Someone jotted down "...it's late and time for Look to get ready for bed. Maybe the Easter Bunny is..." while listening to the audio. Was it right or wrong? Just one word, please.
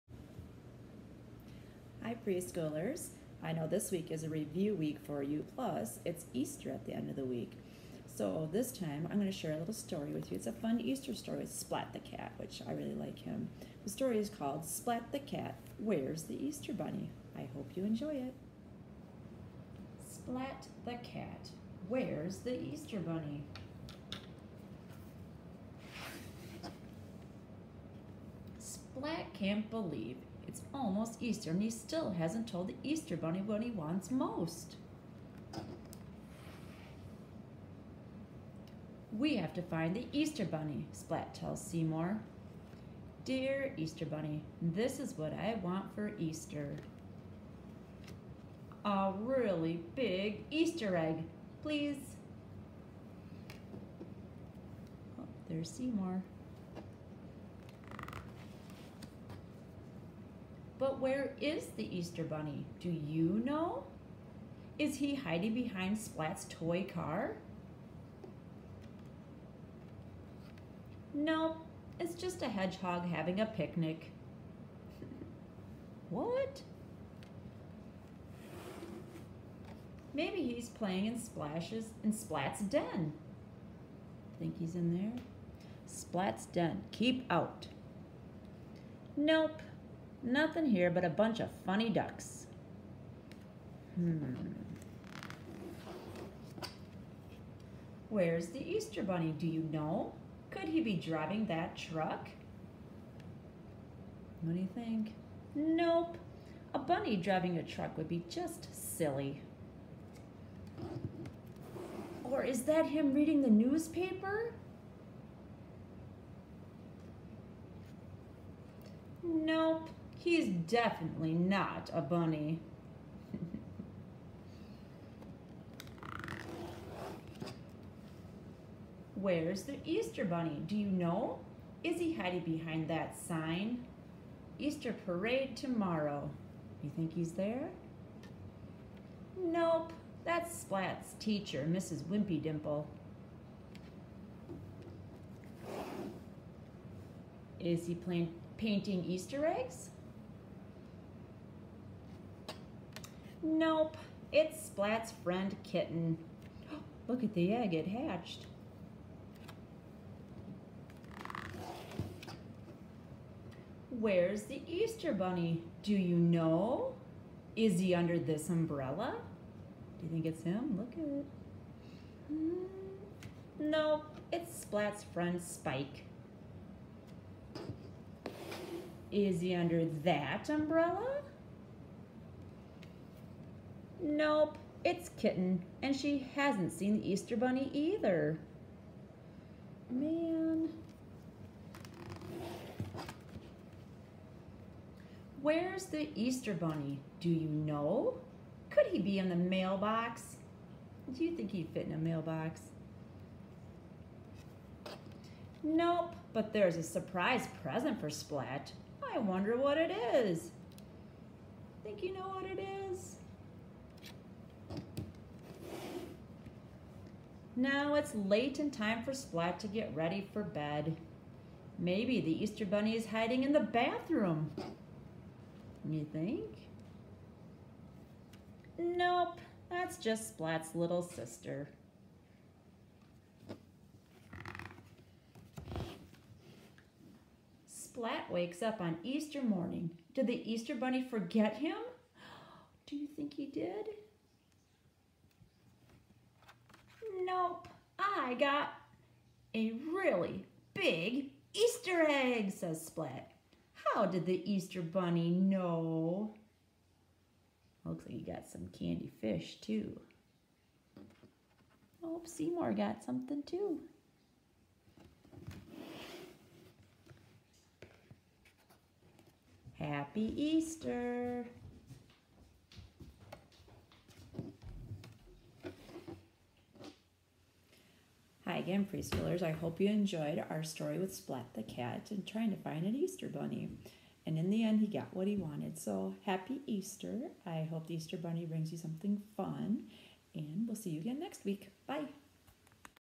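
wrong.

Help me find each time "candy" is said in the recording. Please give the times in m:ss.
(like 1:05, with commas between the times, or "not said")
4:18.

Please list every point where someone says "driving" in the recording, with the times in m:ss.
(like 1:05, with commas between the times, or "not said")
1:40, 1:47.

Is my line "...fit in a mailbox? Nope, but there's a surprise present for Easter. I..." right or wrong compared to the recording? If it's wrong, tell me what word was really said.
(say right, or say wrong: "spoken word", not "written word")
wrong: "Splat", not "Easter".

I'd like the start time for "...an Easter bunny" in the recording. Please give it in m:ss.
4:42.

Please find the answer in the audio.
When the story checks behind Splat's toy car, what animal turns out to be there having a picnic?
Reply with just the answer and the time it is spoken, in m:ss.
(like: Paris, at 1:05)
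A hedgehog, at 1:12.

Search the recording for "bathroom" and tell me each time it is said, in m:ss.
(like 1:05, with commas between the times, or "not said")
3:43.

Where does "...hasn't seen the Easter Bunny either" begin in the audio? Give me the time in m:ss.
3:06.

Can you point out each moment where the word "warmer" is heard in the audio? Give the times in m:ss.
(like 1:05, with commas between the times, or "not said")
not said.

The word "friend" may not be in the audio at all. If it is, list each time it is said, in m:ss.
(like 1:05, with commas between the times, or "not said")
2:35, 2:55.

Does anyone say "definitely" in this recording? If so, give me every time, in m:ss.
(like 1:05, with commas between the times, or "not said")
2:00.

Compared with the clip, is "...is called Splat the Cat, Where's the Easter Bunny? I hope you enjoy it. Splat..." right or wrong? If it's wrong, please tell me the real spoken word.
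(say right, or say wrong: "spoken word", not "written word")
right.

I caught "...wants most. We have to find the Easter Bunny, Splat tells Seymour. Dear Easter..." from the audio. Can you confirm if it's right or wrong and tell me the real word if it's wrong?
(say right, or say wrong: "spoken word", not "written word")
right.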